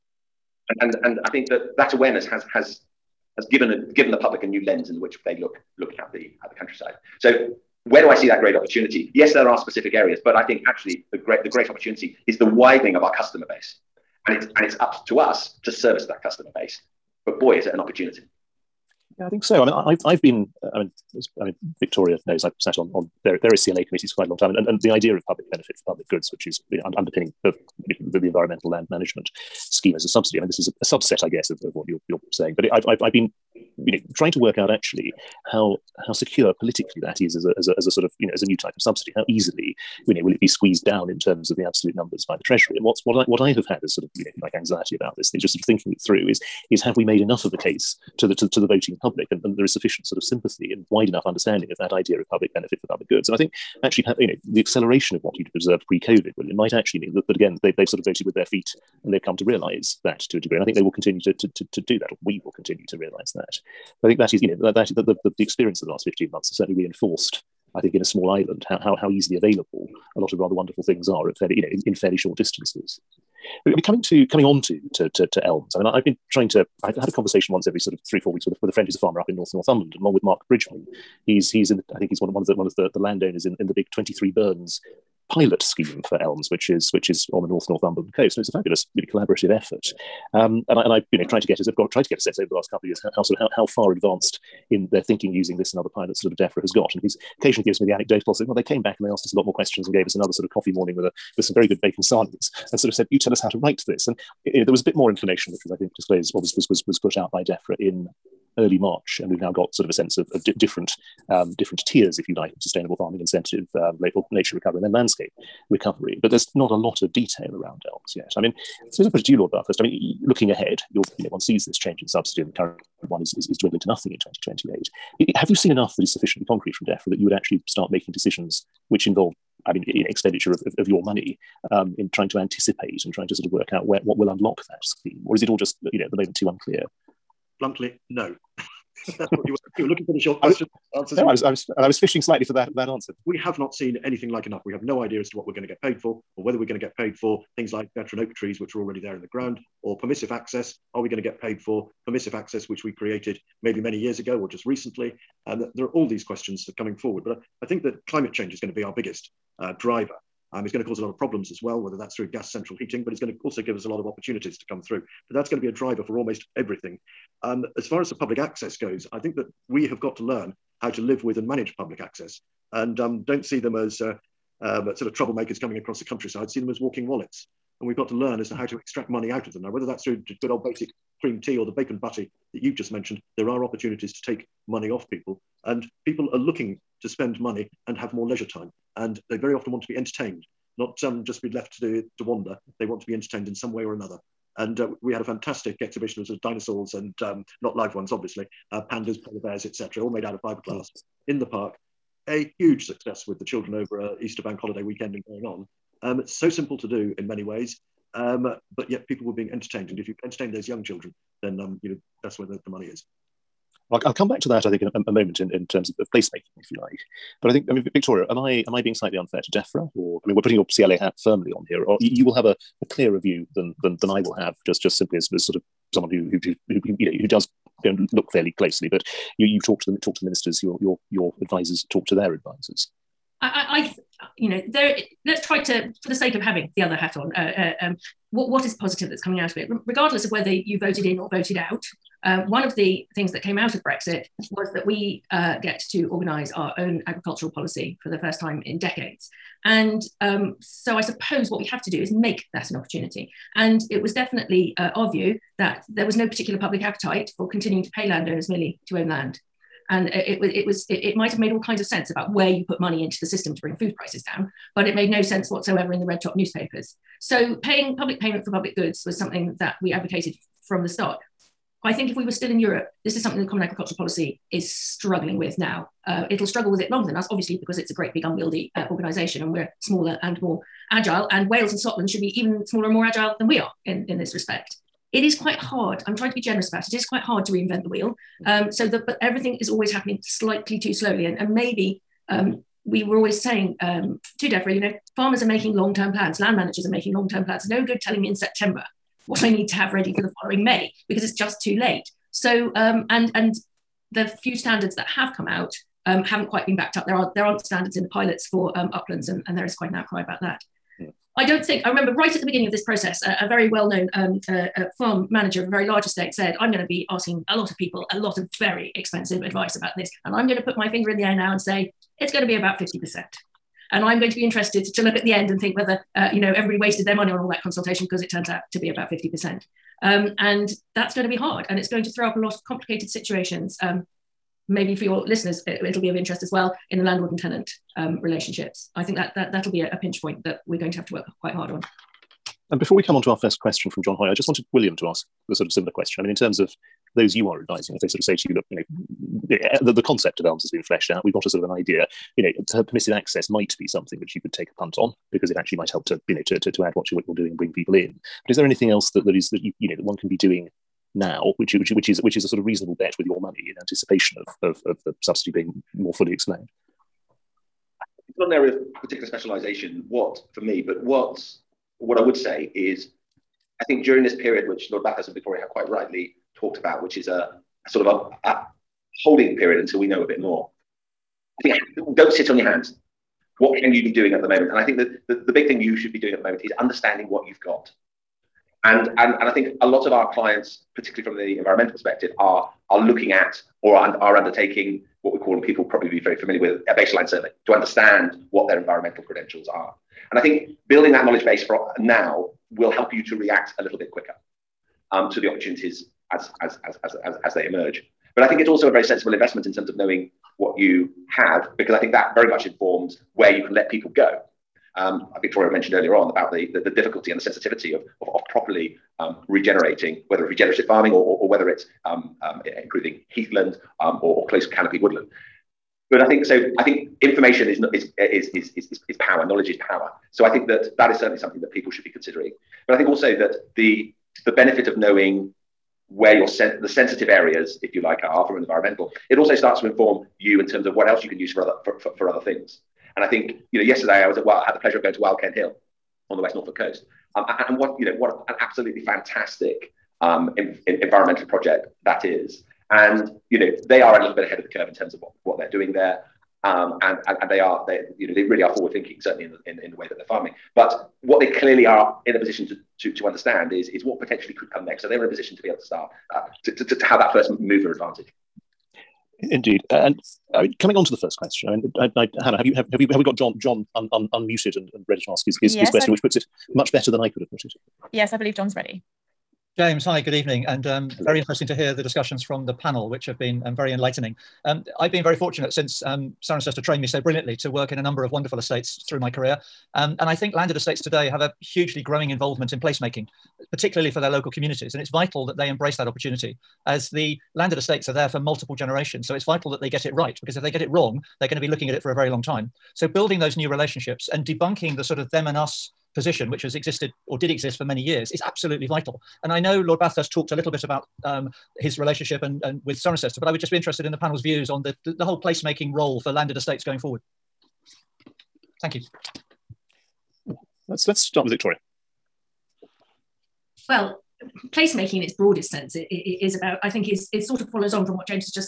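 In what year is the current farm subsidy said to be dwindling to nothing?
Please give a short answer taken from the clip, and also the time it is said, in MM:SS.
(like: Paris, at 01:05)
2028, at 02:04.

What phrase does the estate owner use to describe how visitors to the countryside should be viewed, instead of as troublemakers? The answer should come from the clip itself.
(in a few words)
walking wallets.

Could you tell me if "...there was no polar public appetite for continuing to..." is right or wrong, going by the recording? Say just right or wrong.
wrong.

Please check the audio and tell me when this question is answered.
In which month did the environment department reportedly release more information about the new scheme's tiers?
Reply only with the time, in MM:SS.
01:48.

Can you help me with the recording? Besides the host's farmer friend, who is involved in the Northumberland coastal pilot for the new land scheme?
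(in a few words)
Mark Bridgman.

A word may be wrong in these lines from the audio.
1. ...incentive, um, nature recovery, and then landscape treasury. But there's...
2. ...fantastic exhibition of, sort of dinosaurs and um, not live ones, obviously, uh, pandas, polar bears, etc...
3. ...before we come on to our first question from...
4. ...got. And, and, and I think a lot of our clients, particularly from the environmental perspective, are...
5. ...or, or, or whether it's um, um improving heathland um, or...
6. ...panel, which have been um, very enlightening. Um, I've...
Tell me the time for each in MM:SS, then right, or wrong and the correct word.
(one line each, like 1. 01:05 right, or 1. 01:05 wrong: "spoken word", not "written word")
1. 01:53 wrong: "recovery", not "treasury"
2. 03:15 right
3. 05:42 right
4. 06:27 right
5. 07:01 right
6. 08:02 right.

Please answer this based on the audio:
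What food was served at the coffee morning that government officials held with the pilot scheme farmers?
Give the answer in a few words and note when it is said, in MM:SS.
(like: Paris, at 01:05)
bacon sarnies, at 01:41.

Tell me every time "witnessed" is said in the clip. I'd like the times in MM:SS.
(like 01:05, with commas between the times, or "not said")
not said.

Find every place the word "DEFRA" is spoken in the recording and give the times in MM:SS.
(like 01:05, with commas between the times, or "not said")
01:36, 01:47, 02:06, 03:39, 04:54.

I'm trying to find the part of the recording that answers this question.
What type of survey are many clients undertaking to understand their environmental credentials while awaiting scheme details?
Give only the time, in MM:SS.
06:36.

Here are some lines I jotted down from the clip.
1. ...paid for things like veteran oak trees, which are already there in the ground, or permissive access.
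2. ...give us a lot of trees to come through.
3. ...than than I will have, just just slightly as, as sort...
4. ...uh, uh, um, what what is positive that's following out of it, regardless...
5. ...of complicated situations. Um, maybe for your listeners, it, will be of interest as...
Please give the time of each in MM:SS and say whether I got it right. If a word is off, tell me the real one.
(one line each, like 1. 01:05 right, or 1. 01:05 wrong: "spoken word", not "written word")
1. 02:26 right
2. 02:43 wrong: "opportunities", not "trees"
3. 03:43 wrong: "simply", not "slightly"
4. 03:57 wrong: "coming", not "following"
5. 05:32 right.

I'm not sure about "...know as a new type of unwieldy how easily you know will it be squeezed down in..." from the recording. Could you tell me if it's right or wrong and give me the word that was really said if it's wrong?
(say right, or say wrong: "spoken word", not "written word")
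wrong: "subsidy", not "unwieldy".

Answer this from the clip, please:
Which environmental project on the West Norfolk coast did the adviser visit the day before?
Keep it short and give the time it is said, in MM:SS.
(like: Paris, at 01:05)
Wild Ken Hill, at 07:25.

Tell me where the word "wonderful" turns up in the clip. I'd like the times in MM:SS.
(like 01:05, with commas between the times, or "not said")
01:10, 08:08.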